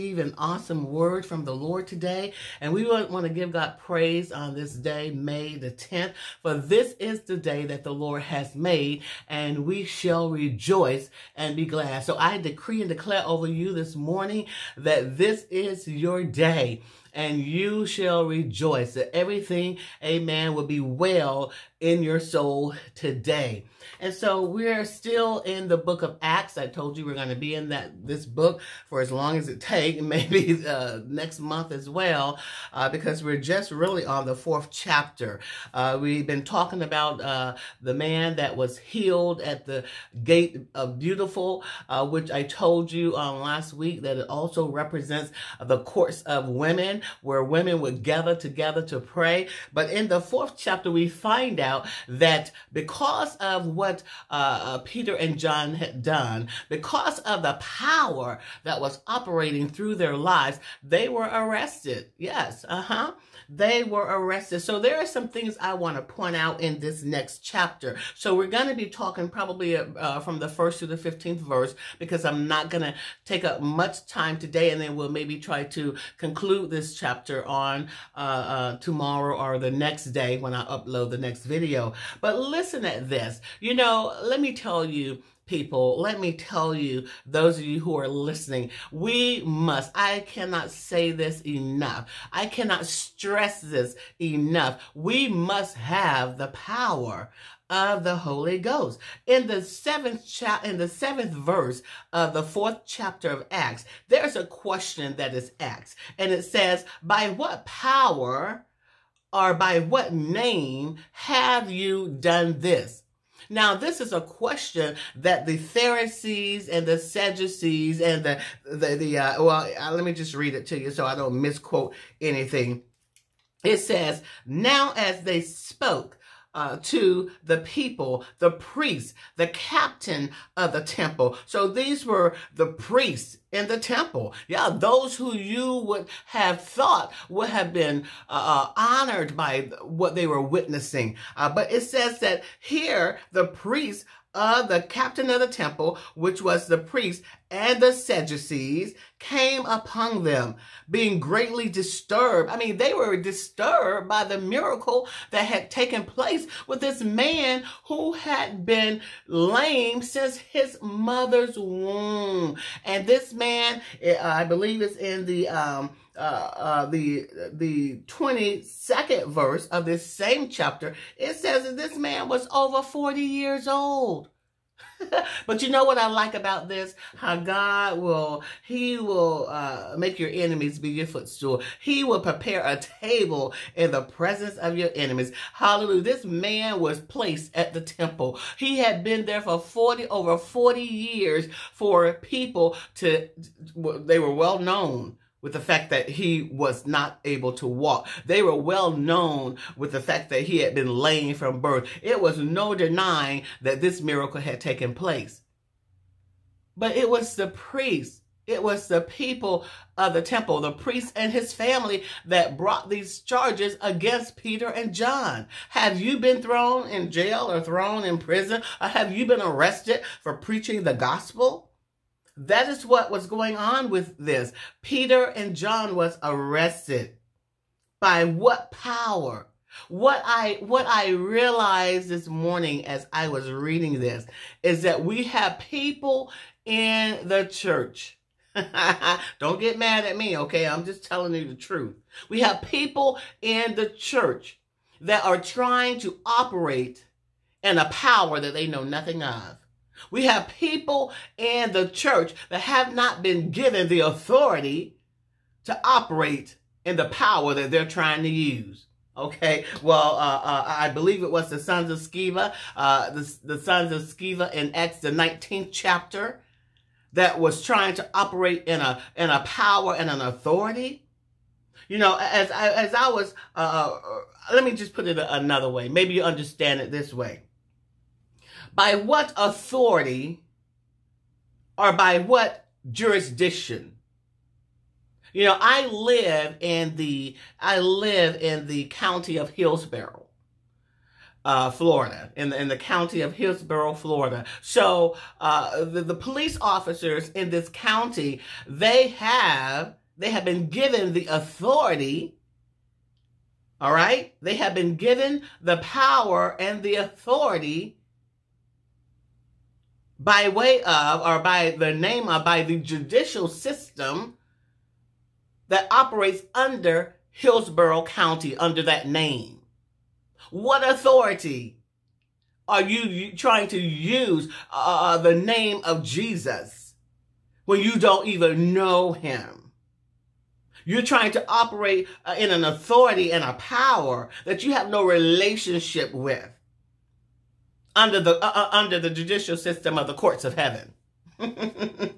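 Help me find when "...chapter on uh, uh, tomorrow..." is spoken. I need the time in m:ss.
1:16.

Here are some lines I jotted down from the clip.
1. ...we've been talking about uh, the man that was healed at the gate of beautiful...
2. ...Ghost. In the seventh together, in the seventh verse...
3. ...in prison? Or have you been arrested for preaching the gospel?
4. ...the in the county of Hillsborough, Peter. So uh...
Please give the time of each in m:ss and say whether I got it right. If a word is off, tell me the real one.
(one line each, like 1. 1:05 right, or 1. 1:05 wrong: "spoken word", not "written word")
1. 0:36 right
2. 1:38 wrong: "chapter", not "together"
3. 3:38 right
4. 4:52 wrong: "Florida", not "Peter".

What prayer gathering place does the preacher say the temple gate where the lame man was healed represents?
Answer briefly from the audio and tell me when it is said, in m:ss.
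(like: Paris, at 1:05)
The courts of women, at 0:45.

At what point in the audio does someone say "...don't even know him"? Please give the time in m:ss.
5:27.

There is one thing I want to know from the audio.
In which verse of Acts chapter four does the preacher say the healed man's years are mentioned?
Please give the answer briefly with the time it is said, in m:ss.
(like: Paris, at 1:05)
22nd verse, at 2:48.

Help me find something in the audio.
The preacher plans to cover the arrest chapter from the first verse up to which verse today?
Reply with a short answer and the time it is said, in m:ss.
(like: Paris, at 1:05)
15th verse, at 1:10.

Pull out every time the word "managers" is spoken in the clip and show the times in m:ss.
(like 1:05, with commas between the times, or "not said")
not said.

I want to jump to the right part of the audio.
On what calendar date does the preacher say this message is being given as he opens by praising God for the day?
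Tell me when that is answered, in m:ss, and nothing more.
0:05.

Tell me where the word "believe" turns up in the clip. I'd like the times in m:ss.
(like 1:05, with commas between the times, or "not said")
2:44, 4:20.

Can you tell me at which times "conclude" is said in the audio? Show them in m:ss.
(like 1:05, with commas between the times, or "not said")
1:16.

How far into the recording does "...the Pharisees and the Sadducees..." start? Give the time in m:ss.
1:55.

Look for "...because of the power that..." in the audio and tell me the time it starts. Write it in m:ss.
0:56.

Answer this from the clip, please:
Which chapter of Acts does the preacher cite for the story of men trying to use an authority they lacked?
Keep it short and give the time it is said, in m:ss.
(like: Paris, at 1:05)
Chapter 19, at 4:25.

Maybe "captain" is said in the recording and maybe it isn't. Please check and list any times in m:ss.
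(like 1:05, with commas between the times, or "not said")
2:09, 2:24.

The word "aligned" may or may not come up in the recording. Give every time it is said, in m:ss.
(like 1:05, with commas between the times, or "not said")
not said.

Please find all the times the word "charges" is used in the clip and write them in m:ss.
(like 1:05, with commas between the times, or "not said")
3:33.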